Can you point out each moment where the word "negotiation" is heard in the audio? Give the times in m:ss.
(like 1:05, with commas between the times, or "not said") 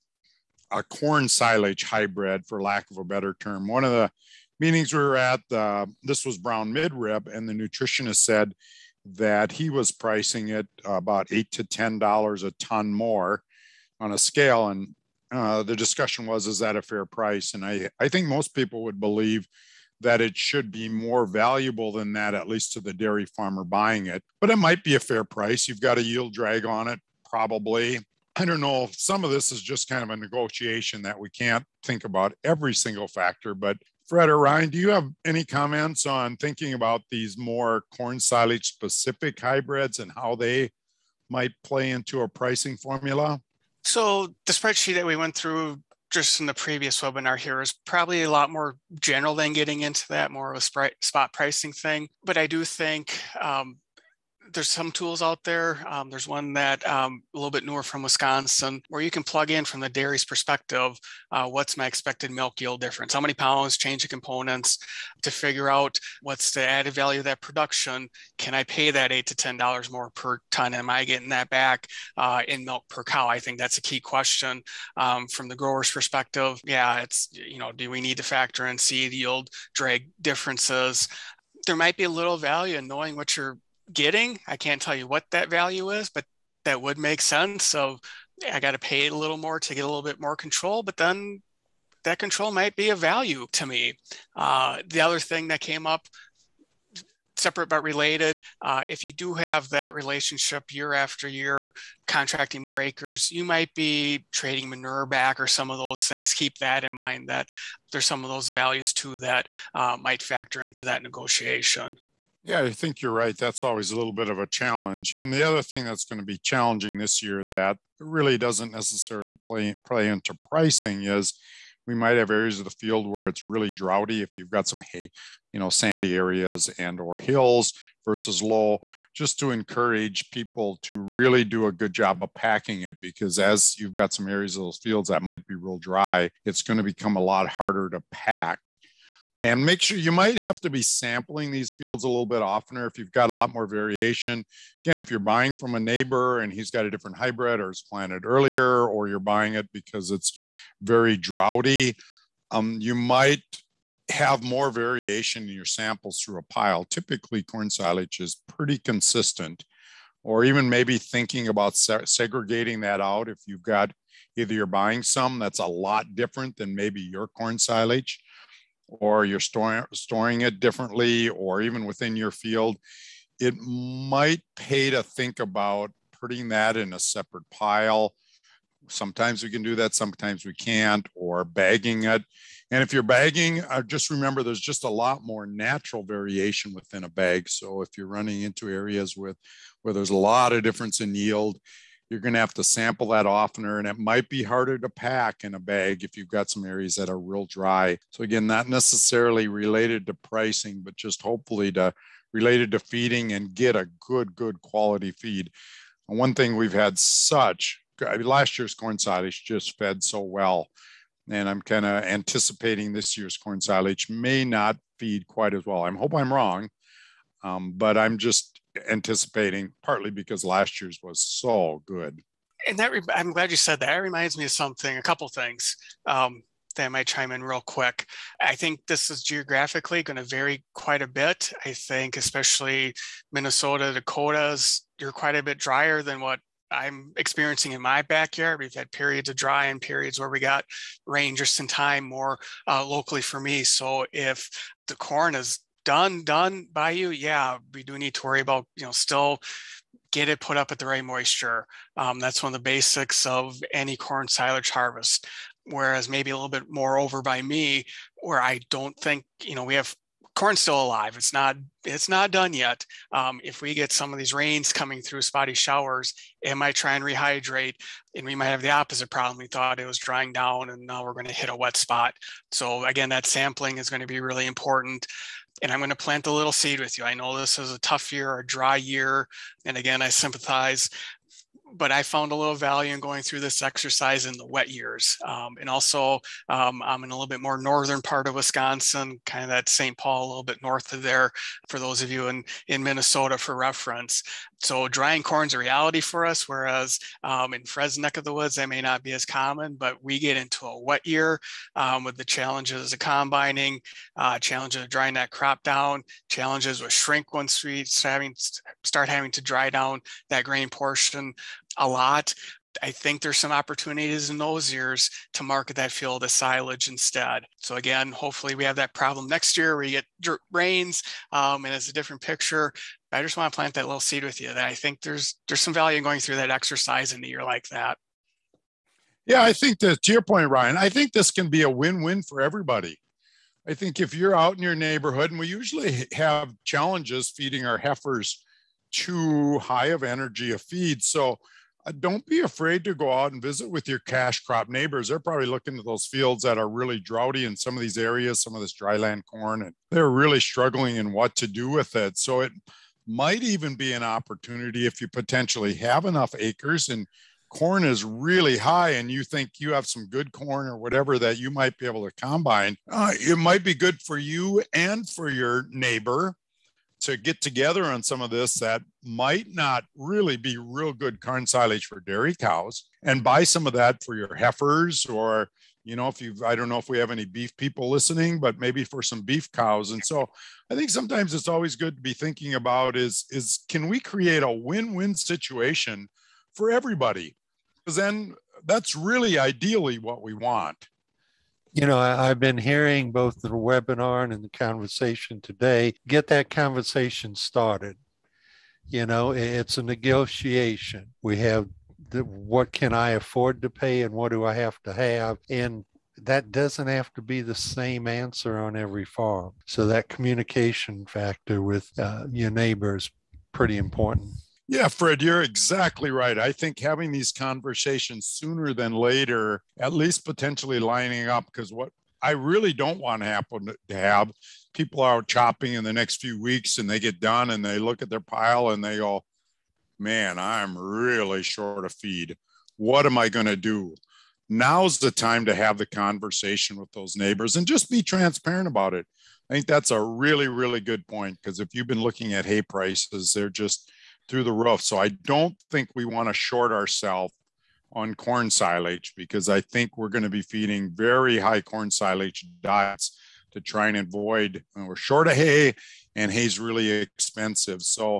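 0:30, 1:51, 6:39.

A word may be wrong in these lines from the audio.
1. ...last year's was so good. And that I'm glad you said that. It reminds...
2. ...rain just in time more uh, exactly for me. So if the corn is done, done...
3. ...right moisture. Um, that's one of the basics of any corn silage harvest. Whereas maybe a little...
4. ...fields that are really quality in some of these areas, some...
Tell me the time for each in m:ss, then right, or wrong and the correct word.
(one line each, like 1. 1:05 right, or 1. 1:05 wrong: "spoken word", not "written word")
1. 3:40 right
2. 4:01 wrong: "locally", not "exactly"
3. 4:10 right
4. 5:46 wrong: "droughty", not "quality".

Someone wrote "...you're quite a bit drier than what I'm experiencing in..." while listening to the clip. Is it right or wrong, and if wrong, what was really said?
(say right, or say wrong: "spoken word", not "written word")
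right.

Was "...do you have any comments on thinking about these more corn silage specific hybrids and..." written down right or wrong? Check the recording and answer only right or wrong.
right.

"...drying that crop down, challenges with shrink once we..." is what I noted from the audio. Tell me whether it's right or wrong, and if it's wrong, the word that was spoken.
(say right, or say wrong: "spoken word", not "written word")
right.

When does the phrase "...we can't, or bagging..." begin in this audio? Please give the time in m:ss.
3:00.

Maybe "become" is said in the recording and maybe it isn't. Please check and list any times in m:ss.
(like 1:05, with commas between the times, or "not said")
2:16.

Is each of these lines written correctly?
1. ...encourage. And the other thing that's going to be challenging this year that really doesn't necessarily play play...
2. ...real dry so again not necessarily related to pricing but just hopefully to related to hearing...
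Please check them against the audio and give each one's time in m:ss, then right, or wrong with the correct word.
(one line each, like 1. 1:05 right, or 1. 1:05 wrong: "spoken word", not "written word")
1. 1:54 wrong: "challenge", not "encourage"
2. 3:17 wrong: "feeding", not "hearing".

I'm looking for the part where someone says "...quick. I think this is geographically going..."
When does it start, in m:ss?
3:47.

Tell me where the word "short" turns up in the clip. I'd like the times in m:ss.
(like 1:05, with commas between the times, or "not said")
7:11, 7:26, 7:34.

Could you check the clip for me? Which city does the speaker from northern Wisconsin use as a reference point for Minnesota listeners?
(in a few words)
St. Paul.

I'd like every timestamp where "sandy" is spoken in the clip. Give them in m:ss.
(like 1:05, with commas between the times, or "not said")
2:05.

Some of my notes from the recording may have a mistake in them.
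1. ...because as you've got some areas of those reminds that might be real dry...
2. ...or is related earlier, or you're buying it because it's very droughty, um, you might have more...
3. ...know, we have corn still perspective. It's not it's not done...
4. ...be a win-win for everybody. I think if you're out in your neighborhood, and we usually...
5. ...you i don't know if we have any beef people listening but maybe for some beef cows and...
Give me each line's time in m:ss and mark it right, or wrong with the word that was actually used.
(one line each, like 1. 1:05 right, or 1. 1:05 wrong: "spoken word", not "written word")
1. 2:12 wrong: "fields", not "reminds"
2. 2:27 wrong: "planted", not "related"
3. 4:19 wrong: "alive", not "perspective"
4. 5:31 right
5. 6:16 right.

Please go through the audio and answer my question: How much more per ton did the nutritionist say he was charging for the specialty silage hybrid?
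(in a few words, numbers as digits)
$8 to $10.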